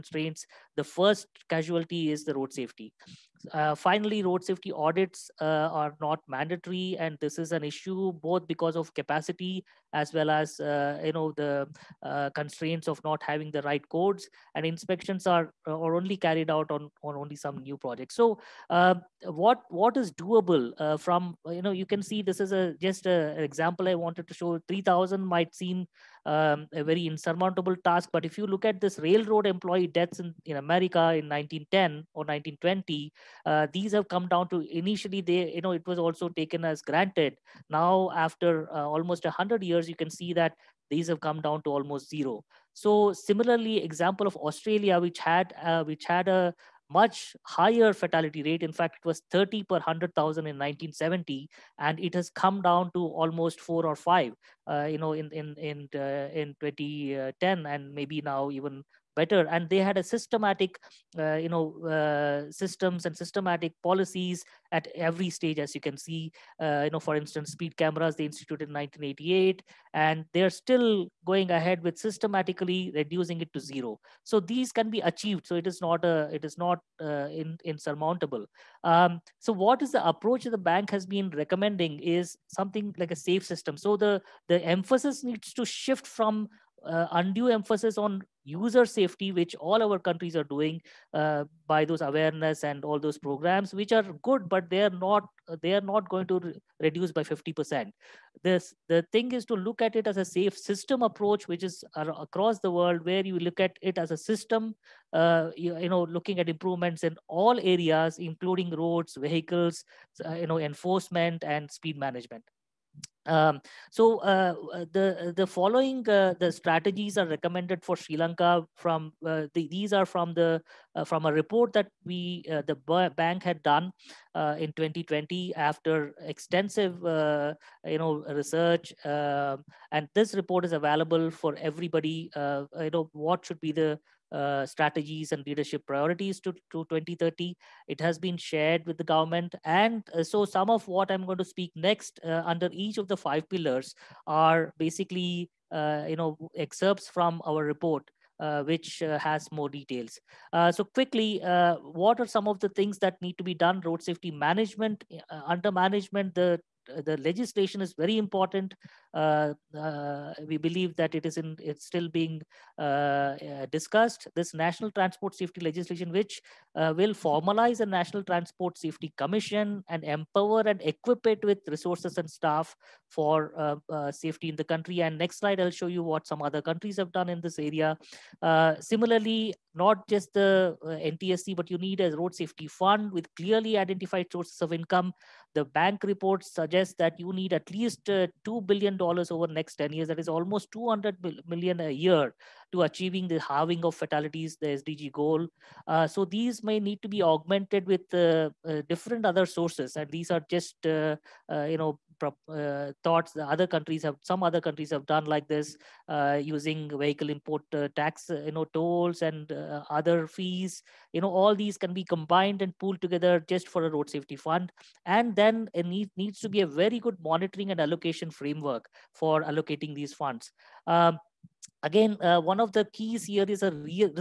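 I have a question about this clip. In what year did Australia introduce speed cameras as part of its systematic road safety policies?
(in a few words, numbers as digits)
1988.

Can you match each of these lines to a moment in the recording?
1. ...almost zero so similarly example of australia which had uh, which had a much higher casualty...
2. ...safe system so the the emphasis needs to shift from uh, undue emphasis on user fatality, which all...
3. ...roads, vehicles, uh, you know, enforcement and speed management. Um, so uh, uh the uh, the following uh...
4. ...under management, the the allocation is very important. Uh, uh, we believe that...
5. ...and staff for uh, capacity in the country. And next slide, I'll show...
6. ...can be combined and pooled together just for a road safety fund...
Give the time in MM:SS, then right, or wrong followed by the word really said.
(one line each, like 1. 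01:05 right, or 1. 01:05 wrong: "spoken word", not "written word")
1. 00:41 wrong: "fatality", not "casualty"
2. 01:23 wrong: "safety", not "fatality"
3. 01:48 right
4. 02:35 wrong: "legislation", not "allocation"
5. 02:52 wrong: "safety", not "capacity"
6. 03:31 right.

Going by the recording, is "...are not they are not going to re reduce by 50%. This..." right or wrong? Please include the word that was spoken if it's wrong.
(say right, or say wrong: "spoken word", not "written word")
right.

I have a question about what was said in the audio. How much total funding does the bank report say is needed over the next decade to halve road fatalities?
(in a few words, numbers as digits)
$2 billion.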